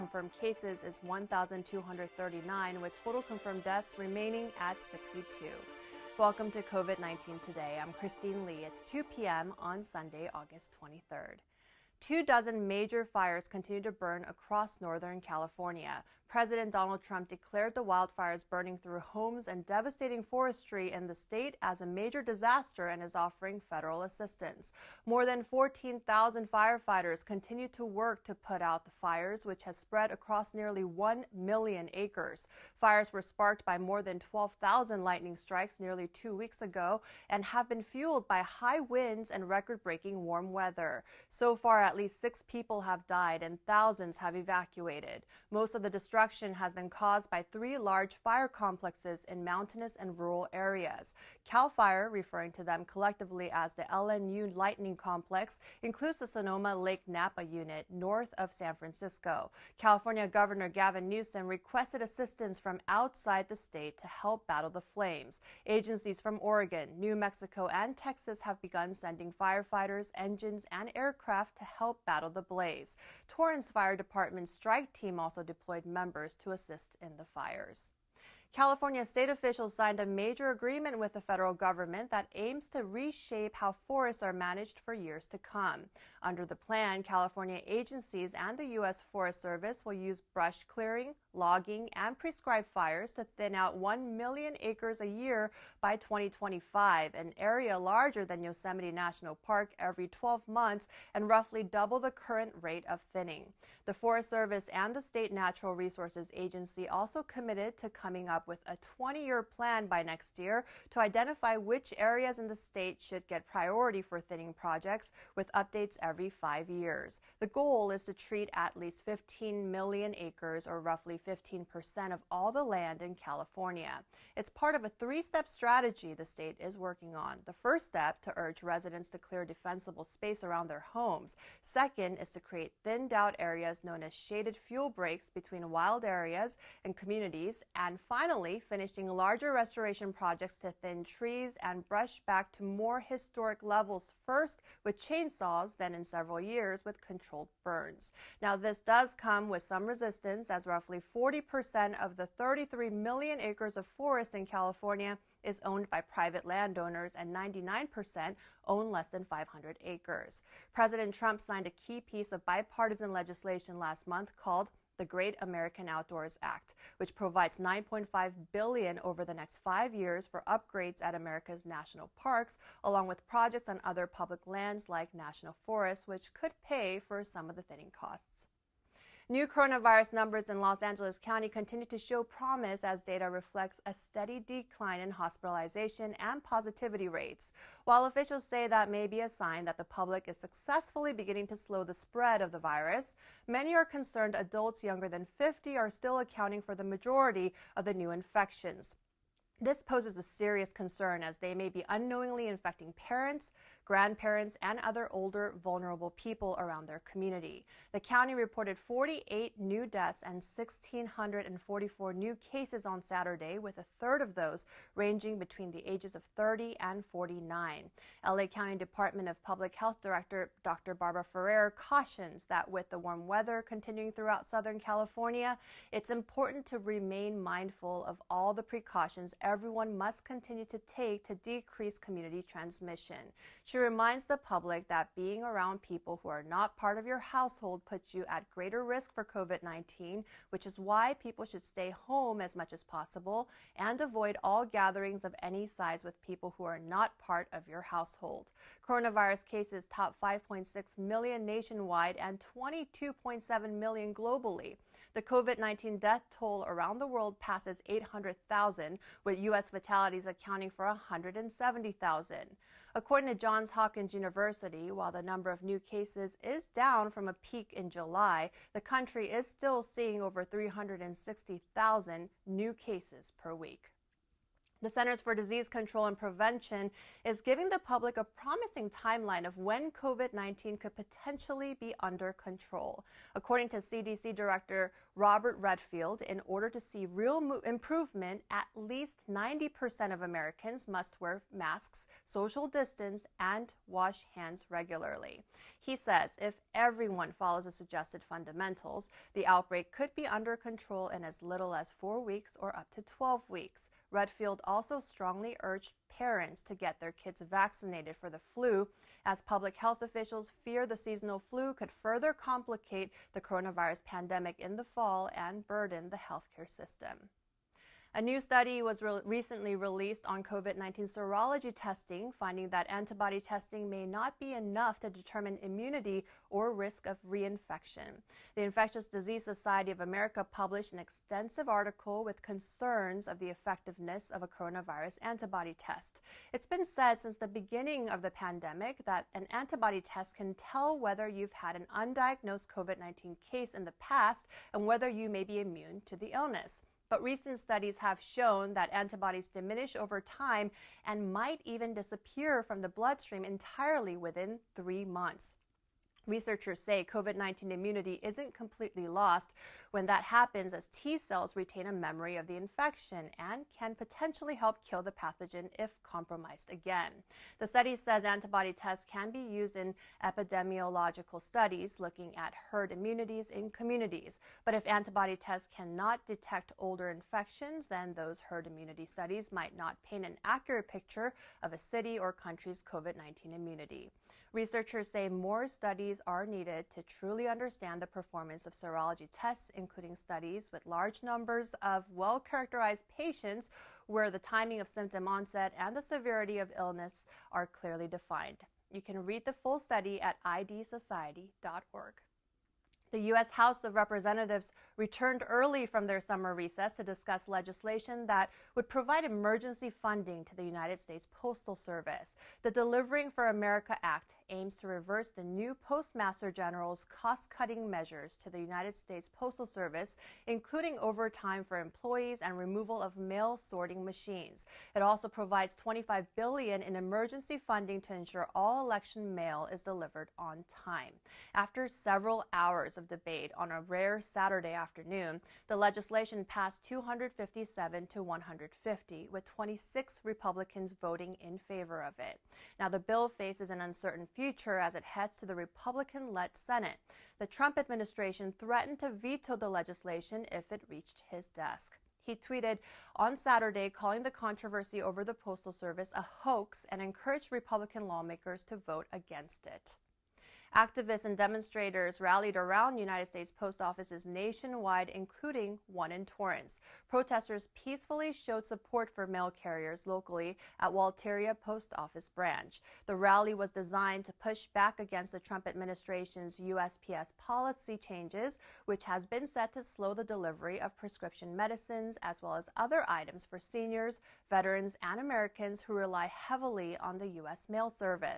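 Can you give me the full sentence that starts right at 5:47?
But recent studies have shown that antibodies diminish over time and might even disappear from the bloodstream entirely within three months.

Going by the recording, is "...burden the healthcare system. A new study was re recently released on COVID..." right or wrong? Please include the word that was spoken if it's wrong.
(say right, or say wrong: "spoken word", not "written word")
right.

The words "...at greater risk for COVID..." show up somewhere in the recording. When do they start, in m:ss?
3:58.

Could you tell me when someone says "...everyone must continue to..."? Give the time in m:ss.
3:49.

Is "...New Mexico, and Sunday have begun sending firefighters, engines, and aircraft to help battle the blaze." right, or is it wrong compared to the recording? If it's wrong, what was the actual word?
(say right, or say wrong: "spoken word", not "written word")
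wrong: "Texas", not "Sunday".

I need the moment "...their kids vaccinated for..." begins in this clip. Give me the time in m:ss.
5:07.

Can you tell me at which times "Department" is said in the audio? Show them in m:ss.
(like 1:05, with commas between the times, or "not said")
1:13, 3:38.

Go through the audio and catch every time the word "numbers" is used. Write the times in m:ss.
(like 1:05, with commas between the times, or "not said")
3:00, 4:25, 6:31.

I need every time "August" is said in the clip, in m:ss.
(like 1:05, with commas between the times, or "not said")
0:10.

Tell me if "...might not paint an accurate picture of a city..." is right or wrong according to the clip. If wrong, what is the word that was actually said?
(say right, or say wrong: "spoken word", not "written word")
right.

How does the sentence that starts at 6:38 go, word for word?
You can read the full study at idsociety.org.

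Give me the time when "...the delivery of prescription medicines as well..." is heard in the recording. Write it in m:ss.
8:00.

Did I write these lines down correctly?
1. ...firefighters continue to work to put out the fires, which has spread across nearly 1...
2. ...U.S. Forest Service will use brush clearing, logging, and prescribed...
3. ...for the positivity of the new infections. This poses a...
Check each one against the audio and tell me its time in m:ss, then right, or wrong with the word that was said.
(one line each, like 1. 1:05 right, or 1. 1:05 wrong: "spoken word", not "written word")
1. 0:26 right
2. 1:28 right
3. 3:16 wrong: "majority", not "positivity".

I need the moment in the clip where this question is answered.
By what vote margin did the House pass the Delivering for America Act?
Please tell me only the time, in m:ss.
7:16.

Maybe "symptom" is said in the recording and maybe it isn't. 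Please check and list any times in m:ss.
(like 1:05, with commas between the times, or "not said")
6:34.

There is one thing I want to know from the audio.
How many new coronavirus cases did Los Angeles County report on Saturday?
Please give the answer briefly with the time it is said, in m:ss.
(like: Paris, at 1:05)
1,644, at 3:30.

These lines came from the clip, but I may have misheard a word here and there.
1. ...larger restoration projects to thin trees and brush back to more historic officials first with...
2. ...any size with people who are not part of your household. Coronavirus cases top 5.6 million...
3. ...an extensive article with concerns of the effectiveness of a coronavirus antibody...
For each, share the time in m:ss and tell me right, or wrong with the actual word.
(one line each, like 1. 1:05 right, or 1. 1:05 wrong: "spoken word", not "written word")
1. 2:19 wrong: "levels", not "officials"
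2. 4:05 right
3. 5:30 right.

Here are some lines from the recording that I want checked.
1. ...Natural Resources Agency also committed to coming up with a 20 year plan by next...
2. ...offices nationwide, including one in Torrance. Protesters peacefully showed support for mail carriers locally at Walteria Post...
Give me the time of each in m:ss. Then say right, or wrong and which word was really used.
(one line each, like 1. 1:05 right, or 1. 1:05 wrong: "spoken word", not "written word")
1. 1:45 right
2. 7:43 right.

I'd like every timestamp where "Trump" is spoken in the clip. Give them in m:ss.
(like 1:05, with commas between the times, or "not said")
0:17, 2:41, 7:27, 7:55.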